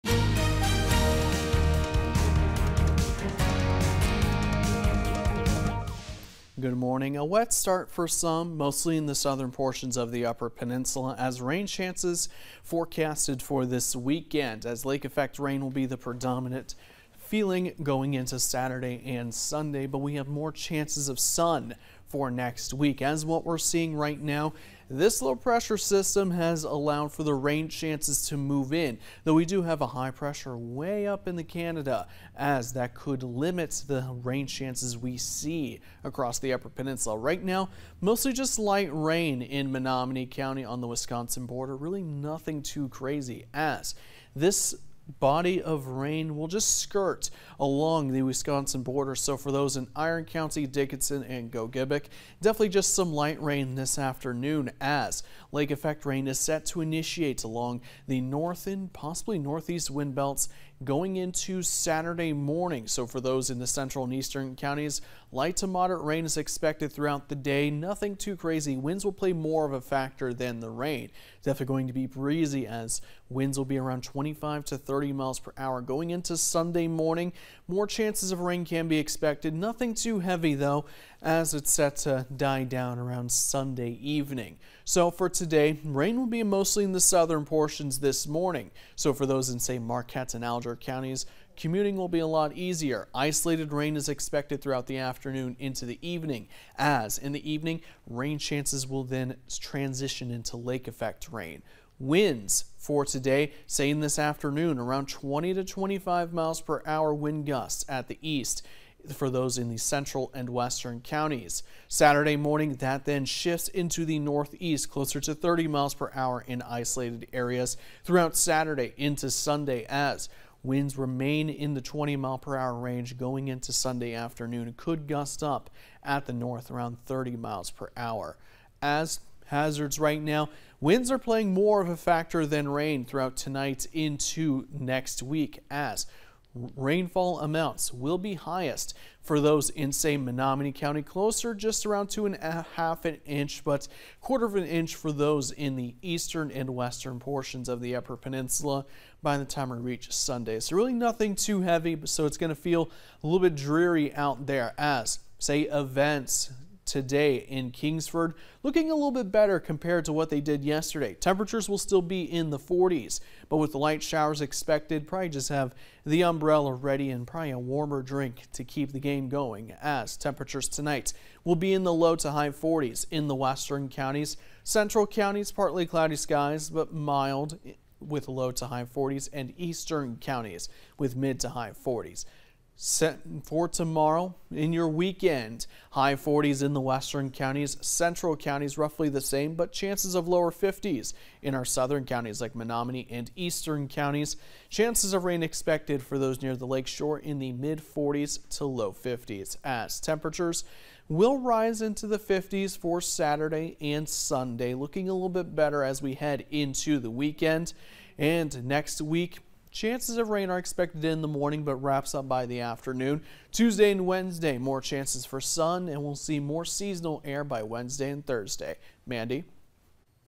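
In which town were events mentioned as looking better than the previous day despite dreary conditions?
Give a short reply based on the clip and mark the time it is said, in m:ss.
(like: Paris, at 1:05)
Kingsford, at 2:37.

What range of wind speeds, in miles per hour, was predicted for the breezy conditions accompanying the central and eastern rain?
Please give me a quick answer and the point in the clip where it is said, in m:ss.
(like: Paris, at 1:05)
25 to 30, at 1:14.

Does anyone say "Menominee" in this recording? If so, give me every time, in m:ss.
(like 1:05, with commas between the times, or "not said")
0:39, 2:20, 3:12.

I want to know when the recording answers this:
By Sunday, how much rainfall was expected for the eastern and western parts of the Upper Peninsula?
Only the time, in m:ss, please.
2:24.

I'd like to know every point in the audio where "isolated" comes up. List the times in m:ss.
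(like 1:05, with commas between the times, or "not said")
1:33, 1:56.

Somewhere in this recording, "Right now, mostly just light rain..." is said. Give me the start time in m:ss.
0:37.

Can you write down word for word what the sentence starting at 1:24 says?
So for today, rain will be mostly in the southern portions this morning.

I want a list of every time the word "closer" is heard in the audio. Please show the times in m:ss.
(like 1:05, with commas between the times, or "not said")
1:54, 2:21.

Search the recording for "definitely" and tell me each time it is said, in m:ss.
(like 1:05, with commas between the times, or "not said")
0:52, 1:11.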